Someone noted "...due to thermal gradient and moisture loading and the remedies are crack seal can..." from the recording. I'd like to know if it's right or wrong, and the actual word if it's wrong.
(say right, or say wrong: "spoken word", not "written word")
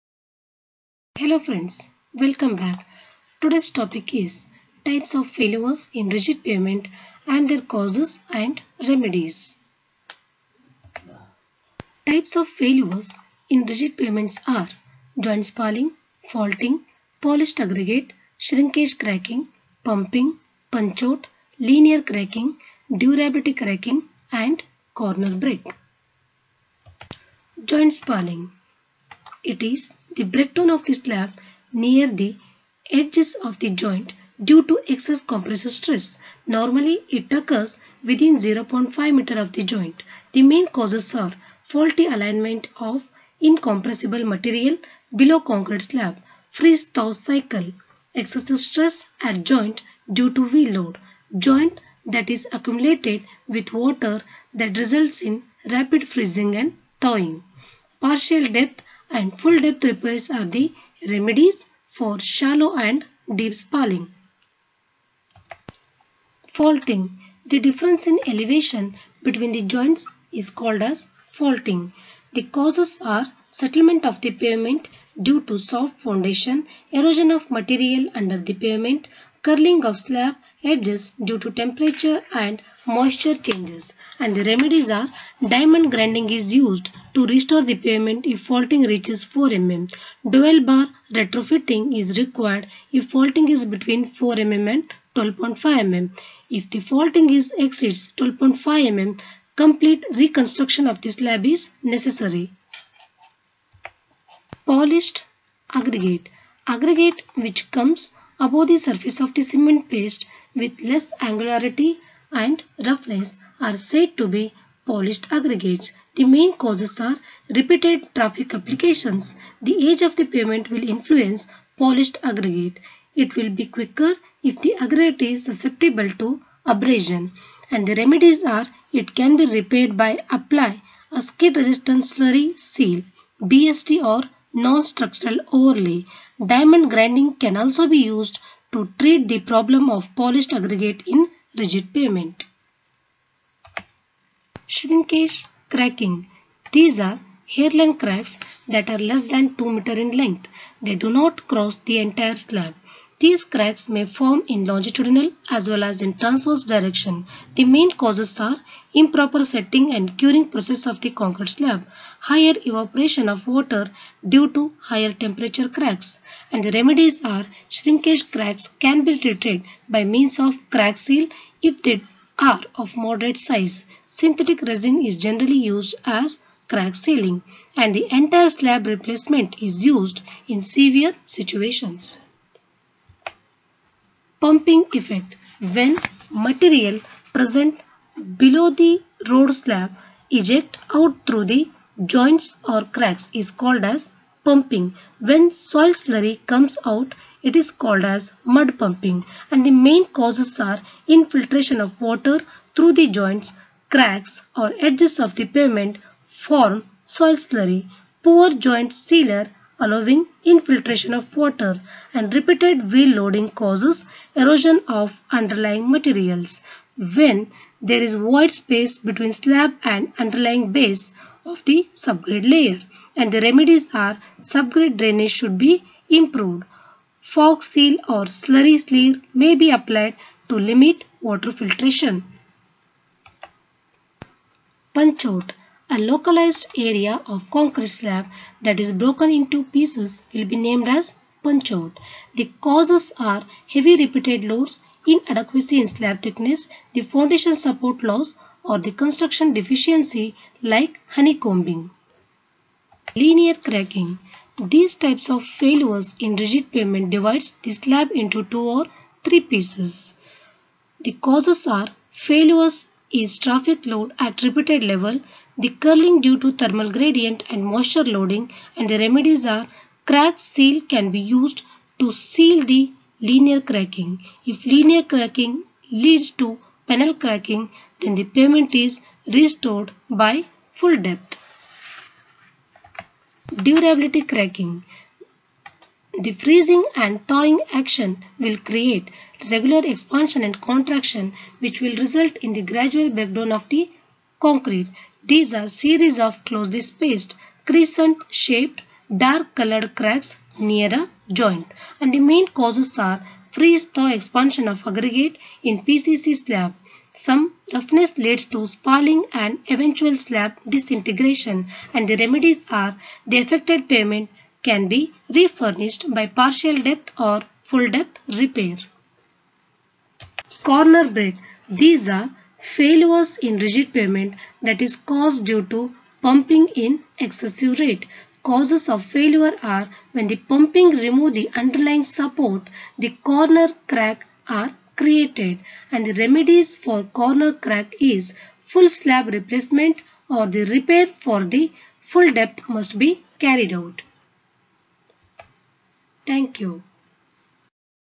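right.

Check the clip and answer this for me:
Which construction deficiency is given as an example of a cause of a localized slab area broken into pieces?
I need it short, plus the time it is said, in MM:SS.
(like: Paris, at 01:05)
Honeycombing, at 04:11.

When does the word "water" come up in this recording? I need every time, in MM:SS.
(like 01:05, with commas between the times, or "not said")
00:53, 02:43, 03:22, 03:31, 03:51.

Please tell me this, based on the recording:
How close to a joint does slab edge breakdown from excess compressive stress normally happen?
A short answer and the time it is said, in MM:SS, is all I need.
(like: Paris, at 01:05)
0.5 meter, at 00:38.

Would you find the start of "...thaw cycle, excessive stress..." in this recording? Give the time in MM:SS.
00:46.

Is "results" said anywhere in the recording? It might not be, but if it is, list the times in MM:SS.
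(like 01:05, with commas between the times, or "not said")
00:54, 04:51.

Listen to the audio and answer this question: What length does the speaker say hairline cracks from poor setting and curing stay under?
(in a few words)
2 meter.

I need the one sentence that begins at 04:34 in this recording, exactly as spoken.
If linear cracking leads to panel cracking then the pavement is restored by full depth durability cracking.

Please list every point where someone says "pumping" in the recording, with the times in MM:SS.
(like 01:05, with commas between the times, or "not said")
00:19, 03:04, 03:14, 03:18, 05:26, 05:30.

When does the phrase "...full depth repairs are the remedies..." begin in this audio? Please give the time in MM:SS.
00:59.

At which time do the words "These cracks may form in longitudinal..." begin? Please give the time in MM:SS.
02:33.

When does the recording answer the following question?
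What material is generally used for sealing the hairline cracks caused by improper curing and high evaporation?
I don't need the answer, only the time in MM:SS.
02:54.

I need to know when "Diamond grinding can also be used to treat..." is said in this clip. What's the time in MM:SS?
02:16.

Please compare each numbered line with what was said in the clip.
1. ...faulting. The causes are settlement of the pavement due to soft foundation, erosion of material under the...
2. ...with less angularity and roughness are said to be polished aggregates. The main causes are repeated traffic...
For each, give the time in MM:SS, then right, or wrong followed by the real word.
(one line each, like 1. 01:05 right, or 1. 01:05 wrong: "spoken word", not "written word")
1. 01:11 right
2. 01:50 right.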